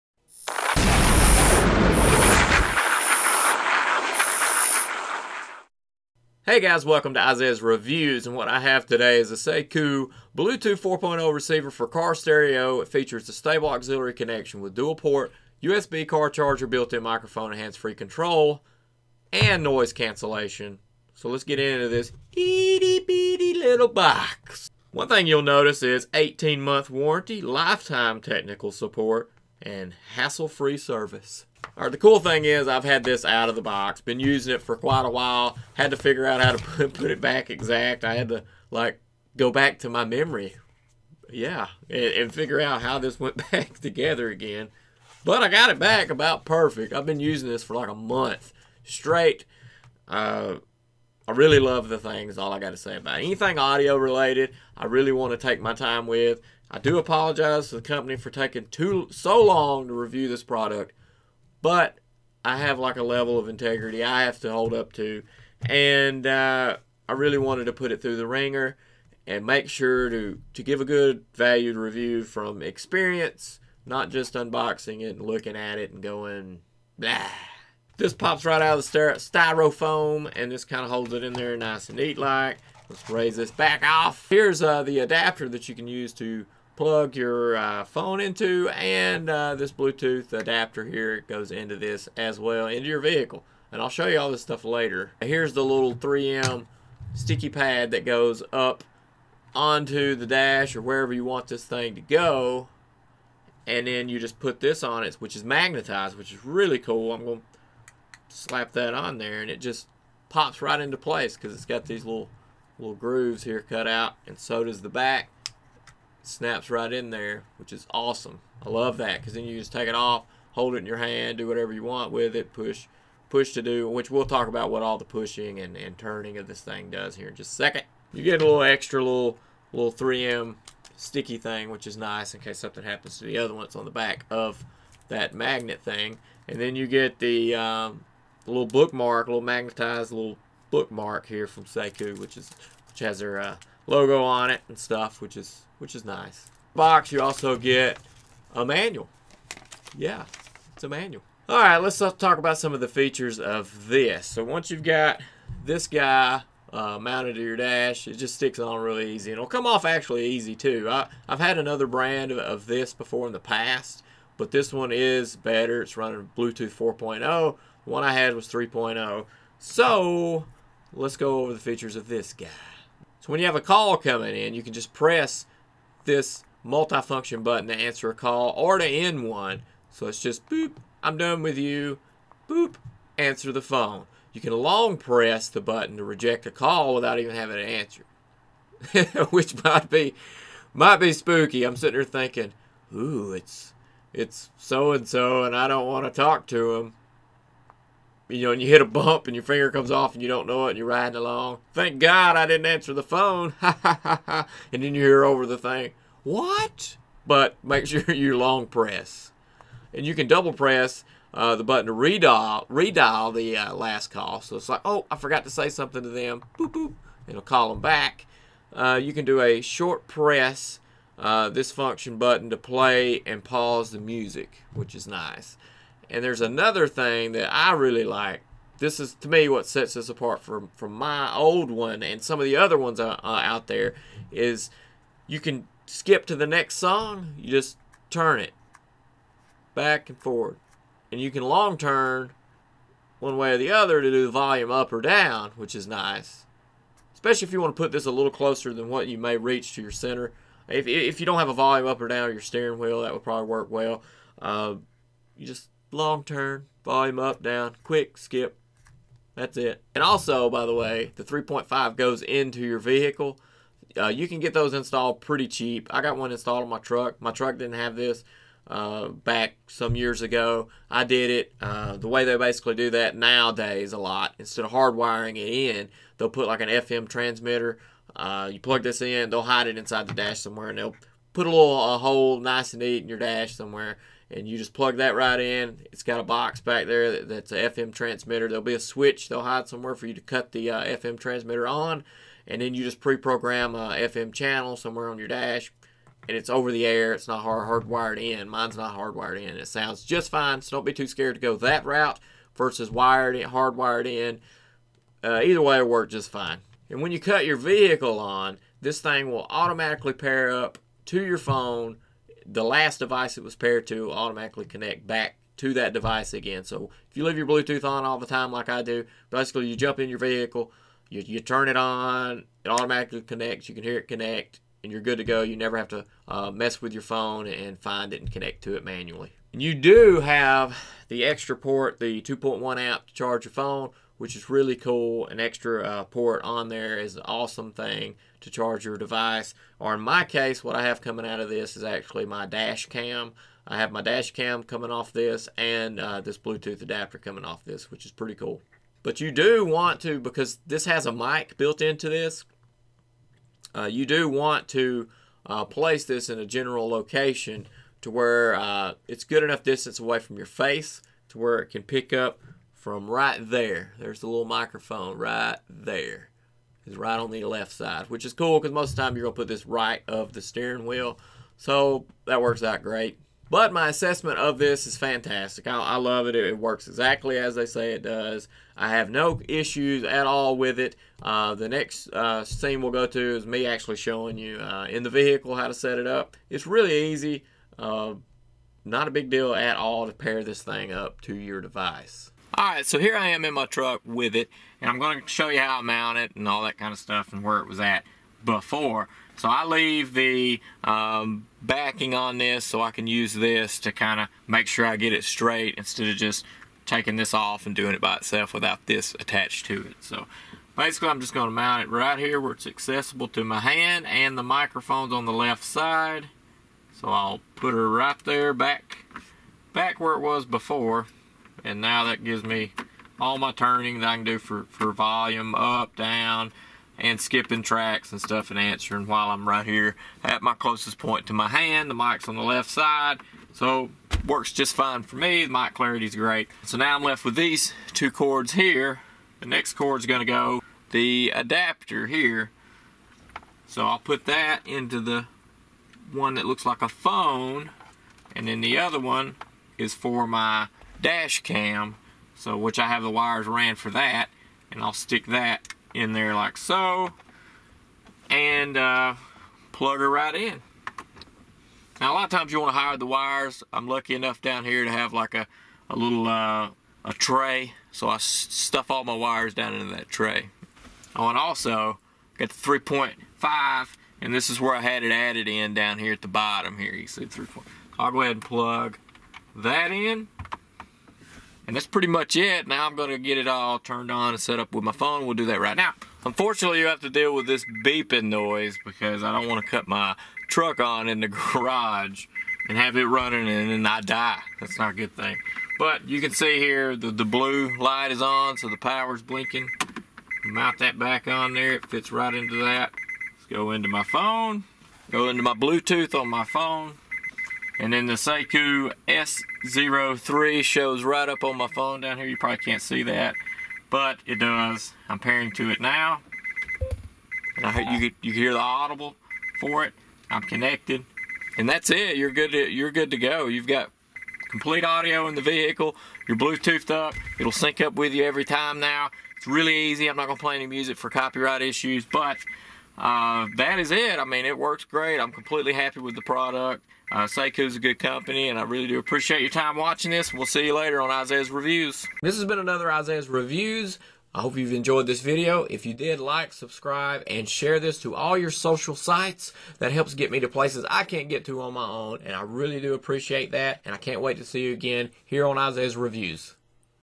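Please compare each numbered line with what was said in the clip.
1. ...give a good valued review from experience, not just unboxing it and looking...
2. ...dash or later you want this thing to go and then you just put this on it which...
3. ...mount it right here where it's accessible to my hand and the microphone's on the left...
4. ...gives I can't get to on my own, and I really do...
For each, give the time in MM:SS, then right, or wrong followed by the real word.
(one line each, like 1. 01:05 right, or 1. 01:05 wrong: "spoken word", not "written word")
1. 01:10 right
2. 01:40 wrong: "wherever", not "later"
3. 06:51 right
4. 09:10 wrong: "places", not "gives".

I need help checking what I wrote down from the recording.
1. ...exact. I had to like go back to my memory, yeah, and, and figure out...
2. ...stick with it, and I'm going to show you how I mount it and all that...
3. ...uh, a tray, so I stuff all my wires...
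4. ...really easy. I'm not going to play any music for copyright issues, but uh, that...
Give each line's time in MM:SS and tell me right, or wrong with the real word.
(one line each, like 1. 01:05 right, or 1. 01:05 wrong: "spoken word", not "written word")
1. 00:37 right
2. 06:33 wrong: "truck", not "stick"
3. 07:46 right
4. 08:49 right.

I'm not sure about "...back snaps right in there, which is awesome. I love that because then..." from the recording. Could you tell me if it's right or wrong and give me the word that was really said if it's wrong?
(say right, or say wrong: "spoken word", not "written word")
right.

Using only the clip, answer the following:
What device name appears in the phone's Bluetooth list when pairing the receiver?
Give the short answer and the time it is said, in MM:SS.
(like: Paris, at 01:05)
Saicoo S03, at 08:28.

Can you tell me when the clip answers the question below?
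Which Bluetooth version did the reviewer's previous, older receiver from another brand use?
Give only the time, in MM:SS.
02:48.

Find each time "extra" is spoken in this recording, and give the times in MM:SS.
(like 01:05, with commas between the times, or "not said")
02:08, 05:31, 05:35.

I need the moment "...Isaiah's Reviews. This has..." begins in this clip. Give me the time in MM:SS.
09:01.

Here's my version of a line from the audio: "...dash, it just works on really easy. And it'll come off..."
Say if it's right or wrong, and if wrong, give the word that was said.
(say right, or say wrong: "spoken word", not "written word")
wrong: "sticks", not "works".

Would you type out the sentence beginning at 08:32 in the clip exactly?
You probably can't see that, but it does.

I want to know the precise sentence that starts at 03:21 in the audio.
Thank God I didn't answer the phone.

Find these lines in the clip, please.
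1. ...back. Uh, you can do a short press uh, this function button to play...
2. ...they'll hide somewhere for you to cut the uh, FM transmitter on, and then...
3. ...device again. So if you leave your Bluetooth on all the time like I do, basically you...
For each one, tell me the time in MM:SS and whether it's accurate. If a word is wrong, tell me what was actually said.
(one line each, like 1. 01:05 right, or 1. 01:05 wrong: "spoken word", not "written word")
1. 03:37 right
2. 04:49 right
3. 05:15 right.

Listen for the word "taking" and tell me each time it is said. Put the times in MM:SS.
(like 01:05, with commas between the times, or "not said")
00:58, 06:46.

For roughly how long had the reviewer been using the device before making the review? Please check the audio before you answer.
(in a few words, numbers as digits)
a month.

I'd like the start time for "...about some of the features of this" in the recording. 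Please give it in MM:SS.
02:32.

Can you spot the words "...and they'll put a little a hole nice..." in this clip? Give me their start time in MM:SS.
04:40.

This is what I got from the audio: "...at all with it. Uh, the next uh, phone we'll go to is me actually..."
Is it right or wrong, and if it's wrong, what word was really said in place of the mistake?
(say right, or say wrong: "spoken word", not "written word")
wrong: "scene", not "phone".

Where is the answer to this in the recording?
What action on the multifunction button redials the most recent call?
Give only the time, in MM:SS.
03:30.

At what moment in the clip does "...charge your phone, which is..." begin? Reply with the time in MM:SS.
05:33.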